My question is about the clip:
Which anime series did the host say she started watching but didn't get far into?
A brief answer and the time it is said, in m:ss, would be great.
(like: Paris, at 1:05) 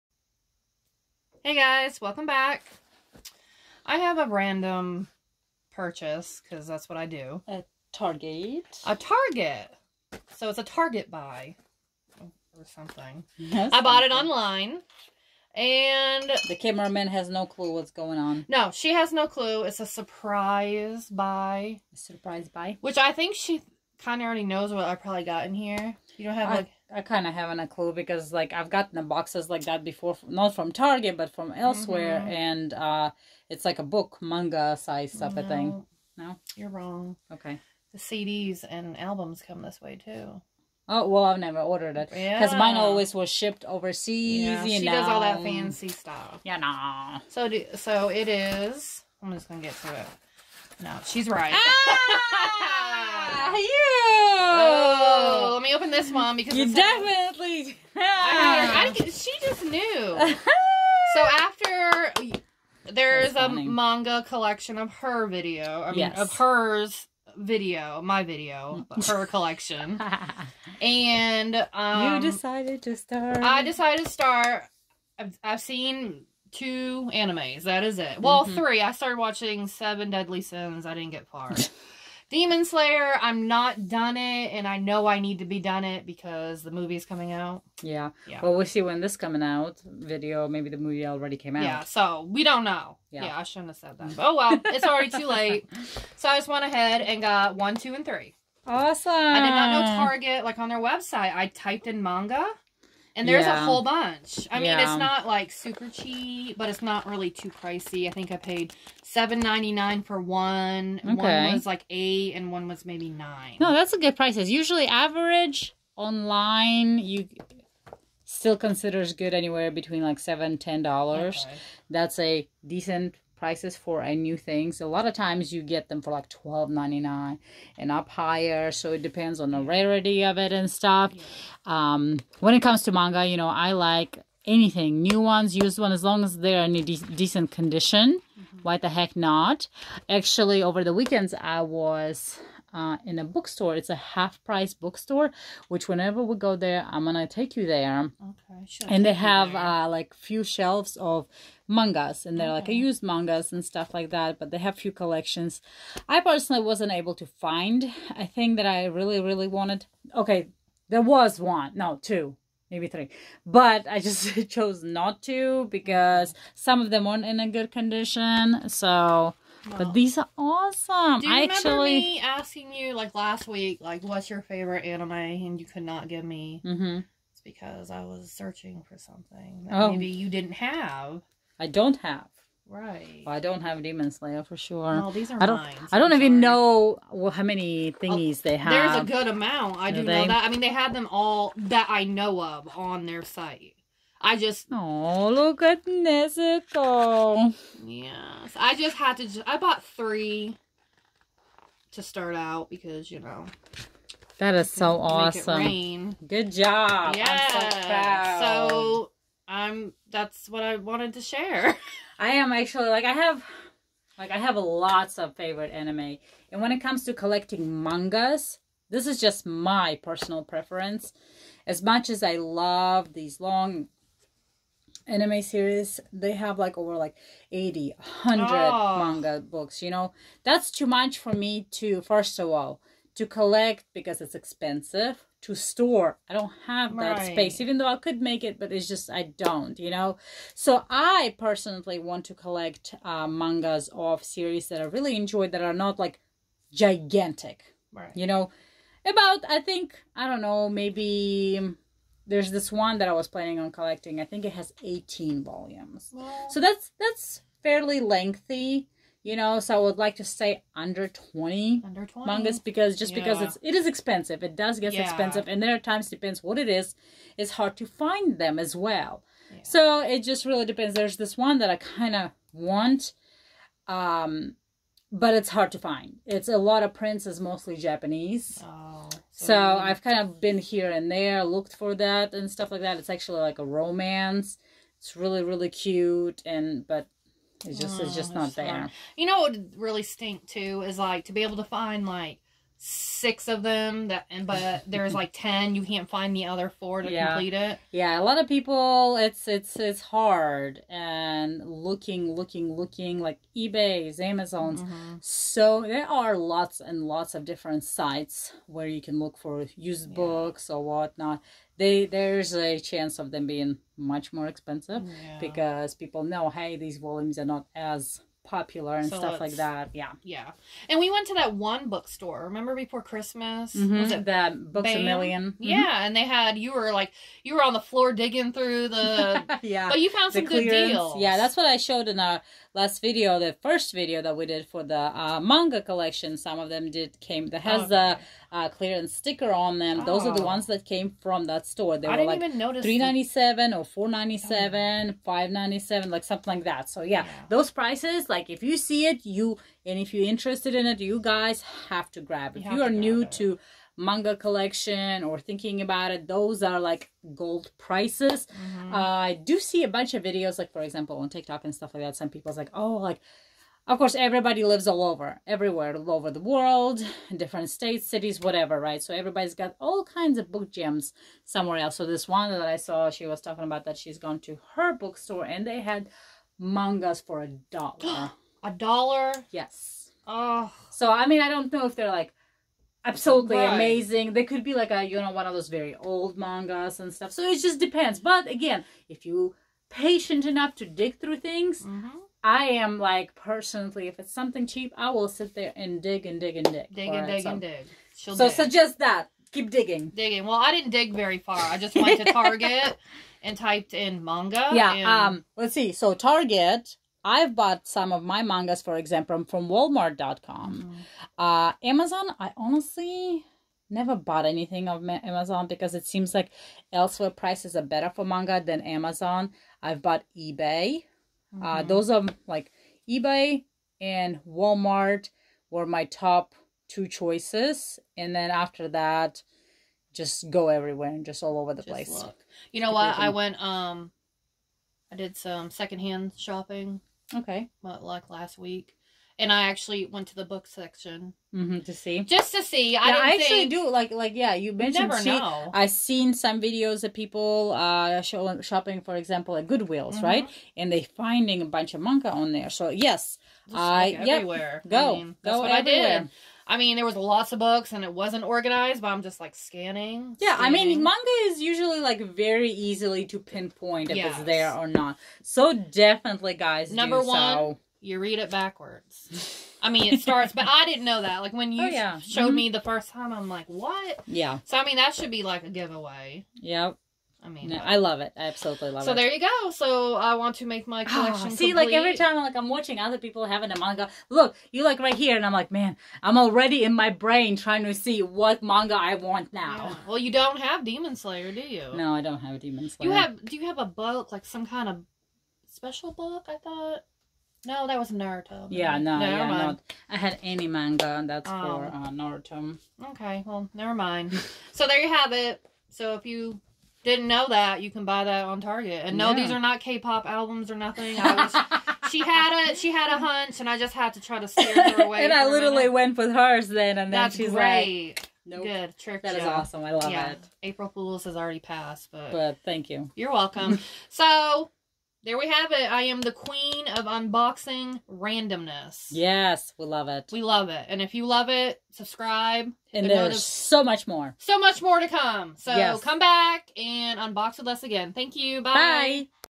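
Seven Deadly Sins, at 1:19.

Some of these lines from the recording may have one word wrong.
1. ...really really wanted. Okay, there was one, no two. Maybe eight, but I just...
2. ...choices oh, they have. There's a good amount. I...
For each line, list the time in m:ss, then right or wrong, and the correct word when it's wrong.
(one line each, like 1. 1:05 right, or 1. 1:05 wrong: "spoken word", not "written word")
1. 2:38 wrong: "three", not "eight"
2. 3:07 wrong: "thingies", not "choices".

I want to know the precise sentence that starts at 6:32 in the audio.
I am like personally, if it's something cheap, I will sit there and dig and dig and dig.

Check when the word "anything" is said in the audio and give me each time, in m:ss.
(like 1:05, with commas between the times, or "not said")
2:14, 6:54.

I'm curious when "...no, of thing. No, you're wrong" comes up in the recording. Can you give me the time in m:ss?
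0:35.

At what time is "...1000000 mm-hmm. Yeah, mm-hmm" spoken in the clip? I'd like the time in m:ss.
5:25.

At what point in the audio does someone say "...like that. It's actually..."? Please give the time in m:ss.
4:42.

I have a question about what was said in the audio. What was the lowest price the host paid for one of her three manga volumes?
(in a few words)
$7.99.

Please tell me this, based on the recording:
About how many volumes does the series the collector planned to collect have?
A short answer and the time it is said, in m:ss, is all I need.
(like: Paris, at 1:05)
18, at 4:14.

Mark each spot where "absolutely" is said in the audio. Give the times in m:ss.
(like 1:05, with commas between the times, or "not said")
6:23, 7:58.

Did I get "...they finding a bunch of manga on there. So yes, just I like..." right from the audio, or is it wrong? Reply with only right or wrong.
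right.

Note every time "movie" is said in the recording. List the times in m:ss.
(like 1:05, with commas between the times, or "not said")
1:26, 1:30.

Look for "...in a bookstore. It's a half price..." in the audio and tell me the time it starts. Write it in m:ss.
2:23.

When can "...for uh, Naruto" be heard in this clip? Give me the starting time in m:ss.
8:21.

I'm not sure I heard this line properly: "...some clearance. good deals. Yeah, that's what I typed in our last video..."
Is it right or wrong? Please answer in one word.
wrong.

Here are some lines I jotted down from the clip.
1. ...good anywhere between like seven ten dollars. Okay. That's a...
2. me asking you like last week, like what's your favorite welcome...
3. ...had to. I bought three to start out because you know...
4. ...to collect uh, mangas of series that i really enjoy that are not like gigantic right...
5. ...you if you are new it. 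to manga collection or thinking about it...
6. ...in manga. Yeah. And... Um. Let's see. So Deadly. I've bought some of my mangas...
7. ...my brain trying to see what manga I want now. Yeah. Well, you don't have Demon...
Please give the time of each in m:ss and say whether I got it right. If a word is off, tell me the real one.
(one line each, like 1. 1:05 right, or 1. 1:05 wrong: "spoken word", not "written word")
1. 1:59 right
2. 2:51 wrong: "anime", not "welcome"
3. 3:18 right
4. 4:02 right
5. 5:52 right
6. 6:43 wrong: "Target", not "Deadly"
7. 8:06 right.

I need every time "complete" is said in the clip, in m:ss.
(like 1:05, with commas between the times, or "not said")
4:57, 8:01.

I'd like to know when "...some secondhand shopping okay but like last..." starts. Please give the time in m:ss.
7:15.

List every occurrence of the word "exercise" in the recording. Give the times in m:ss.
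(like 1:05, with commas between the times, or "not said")
not said.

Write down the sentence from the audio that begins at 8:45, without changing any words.
I am the queen of unboxing randomness.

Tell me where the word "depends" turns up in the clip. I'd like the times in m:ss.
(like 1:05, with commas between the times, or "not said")
2:09, 4:26, 4:30, 6:27.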